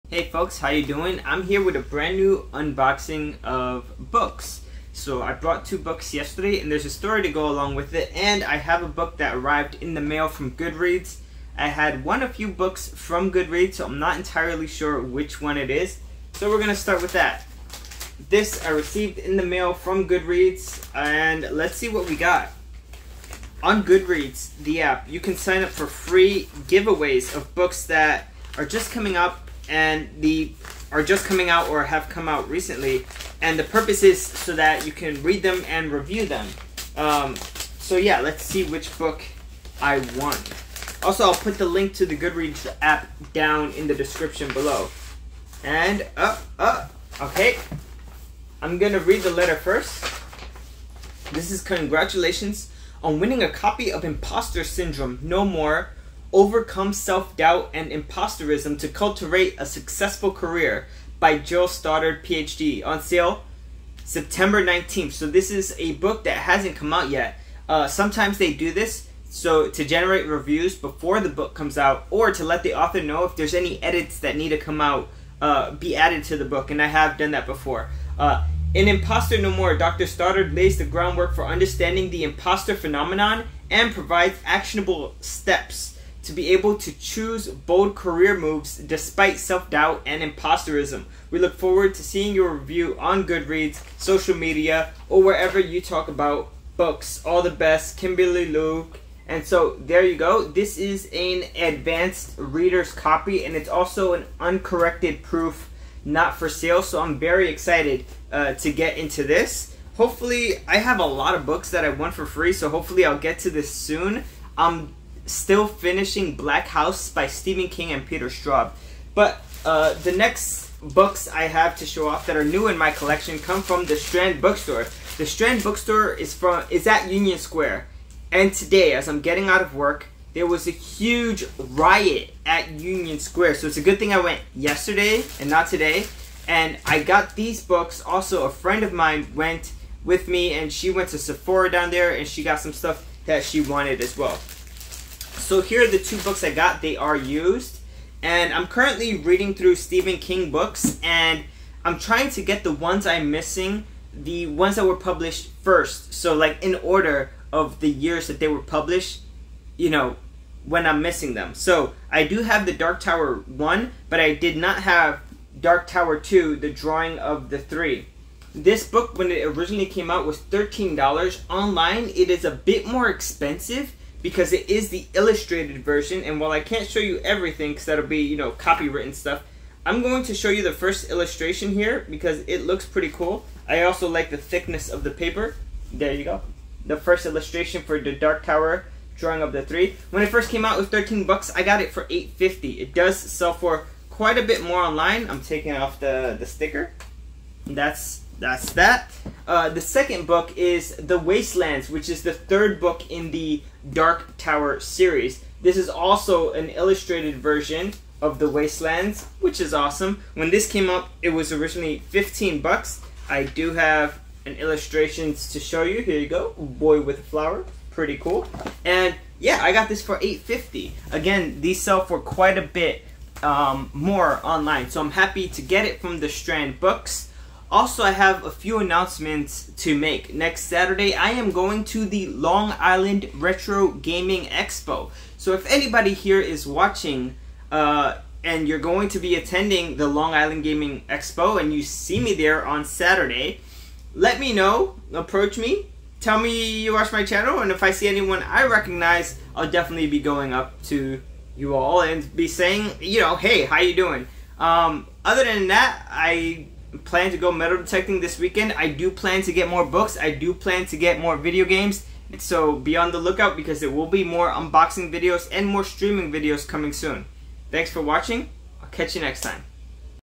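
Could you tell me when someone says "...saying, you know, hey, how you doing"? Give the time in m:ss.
4:12.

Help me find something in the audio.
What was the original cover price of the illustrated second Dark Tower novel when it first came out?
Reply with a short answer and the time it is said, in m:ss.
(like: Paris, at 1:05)
$13, at 3:10.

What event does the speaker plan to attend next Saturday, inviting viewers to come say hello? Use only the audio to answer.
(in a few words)
Long Island Retro Gaming Expo.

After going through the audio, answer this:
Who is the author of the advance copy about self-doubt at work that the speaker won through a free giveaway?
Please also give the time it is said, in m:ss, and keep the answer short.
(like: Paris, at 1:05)
Jill Stoddard, at 1:01.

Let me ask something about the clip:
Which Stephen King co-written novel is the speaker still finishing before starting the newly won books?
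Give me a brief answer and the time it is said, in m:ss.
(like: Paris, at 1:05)
Black House, at 1:56.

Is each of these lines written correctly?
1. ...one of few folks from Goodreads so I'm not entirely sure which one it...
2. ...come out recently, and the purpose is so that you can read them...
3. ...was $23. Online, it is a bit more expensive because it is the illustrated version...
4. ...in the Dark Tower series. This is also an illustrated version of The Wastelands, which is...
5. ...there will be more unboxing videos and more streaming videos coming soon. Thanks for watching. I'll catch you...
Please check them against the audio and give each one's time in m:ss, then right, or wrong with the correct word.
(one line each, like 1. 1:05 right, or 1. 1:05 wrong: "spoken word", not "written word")
1. 0:12 wrong: "books", not "folks"
2. 0:32 right
3. 2:50 wrong: "13", not "23"
4. 3:23 right
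5. 4:23 right.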